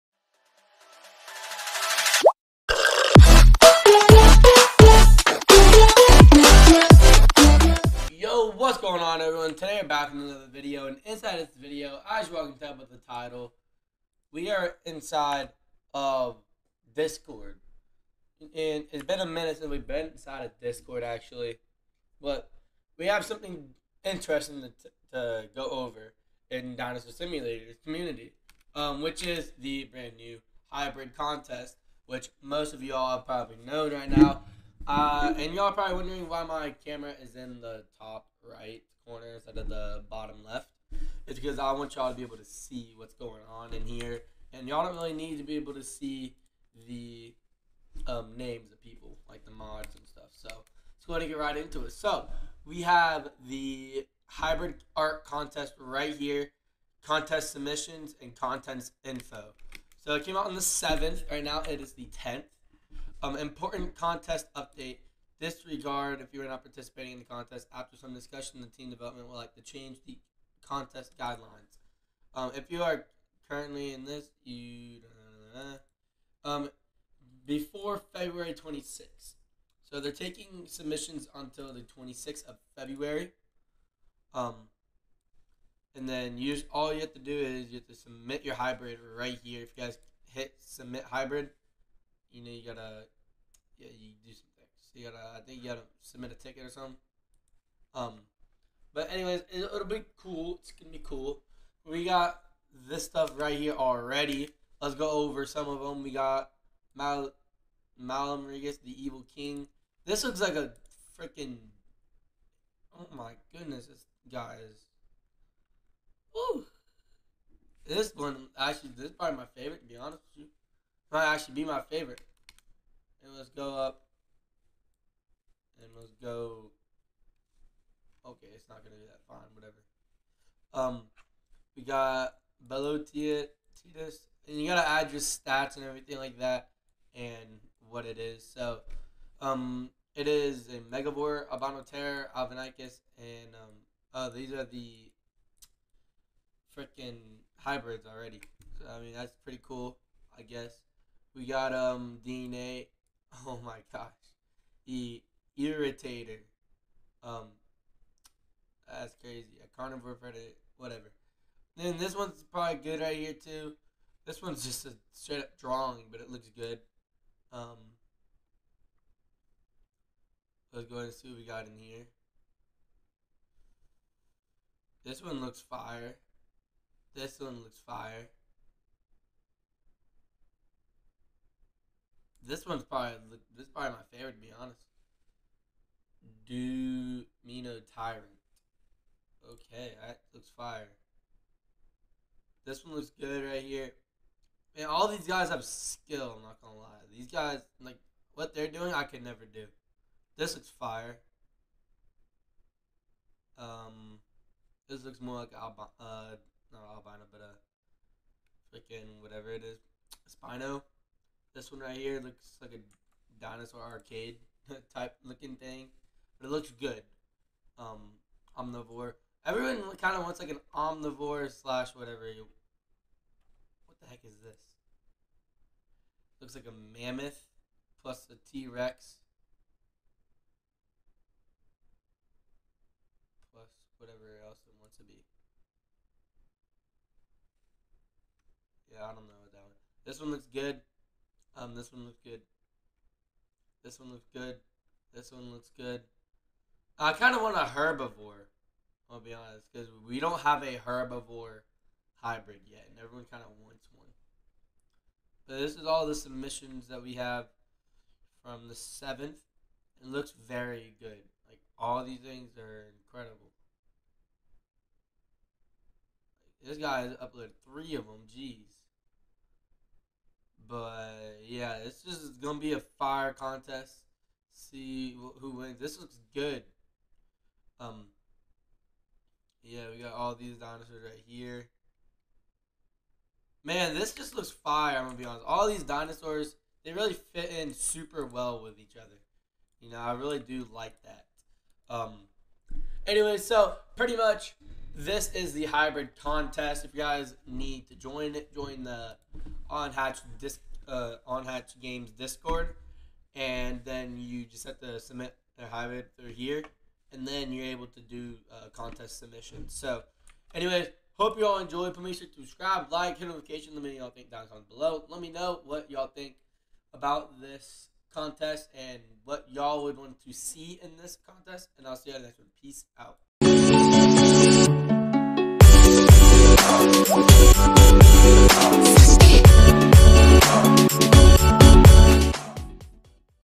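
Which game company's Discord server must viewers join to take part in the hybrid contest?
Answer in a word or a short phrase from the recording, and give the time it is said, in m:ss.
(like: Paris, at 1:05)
Unhatched Games, at 5:01.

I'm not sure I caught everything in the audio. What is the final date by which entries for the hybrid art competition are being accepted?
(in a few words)
February 26th.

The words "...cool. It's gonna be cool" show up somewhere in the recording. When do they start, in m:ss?
1:40.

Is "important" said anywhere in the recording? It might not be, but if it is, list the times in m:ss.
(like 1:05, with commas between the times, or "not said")
1:03.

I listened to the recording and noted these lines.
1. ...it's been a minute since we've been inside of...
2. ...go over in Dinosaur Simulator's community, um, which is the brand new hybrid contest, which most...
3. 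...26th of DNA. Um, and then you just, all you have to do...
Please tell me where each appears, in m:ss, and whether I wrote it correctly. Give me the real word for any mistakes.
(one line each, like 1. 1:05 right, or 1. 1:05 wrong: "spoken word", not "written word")
1. 0:18 right
2. 0:25 right
3. 1:21 wrong: "February", not "DNA".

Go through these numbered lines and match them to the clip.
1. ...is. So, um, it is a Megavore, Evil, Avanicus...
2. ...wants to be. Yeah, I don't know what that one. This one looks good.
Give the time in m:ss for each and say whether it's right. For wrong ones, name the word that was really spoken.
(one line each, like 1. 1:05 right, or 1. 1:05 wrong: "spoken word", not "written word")
1. 2:18 wrong: "Abanoter", not "Evil"
2. 3:54 right.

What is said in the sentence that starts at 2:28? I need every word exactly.
So, I mean, that's pretty cool, I guess.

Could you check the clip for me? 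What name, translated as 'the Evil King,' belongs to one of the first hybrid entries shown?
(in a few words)
Malum Regis.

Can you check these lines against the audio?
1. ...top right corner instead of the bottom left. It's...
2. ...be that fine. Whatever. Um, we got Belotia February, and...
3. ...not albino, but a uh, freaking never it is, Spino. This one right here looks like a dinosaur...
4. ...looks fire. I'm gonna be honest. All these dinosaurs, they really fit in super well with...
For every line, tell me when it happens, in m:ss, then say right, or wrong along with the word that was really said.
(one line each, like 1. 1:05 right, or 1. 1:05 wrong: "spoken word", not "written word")
1. 0:37 right
2. 2:08 wrong: "Titus", not "February"
3. 3:26 wrong: "whatever", not "never"
4. 4:44 right.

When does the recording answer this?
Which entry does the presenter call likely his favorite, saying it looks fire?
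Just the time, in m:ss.
3:06.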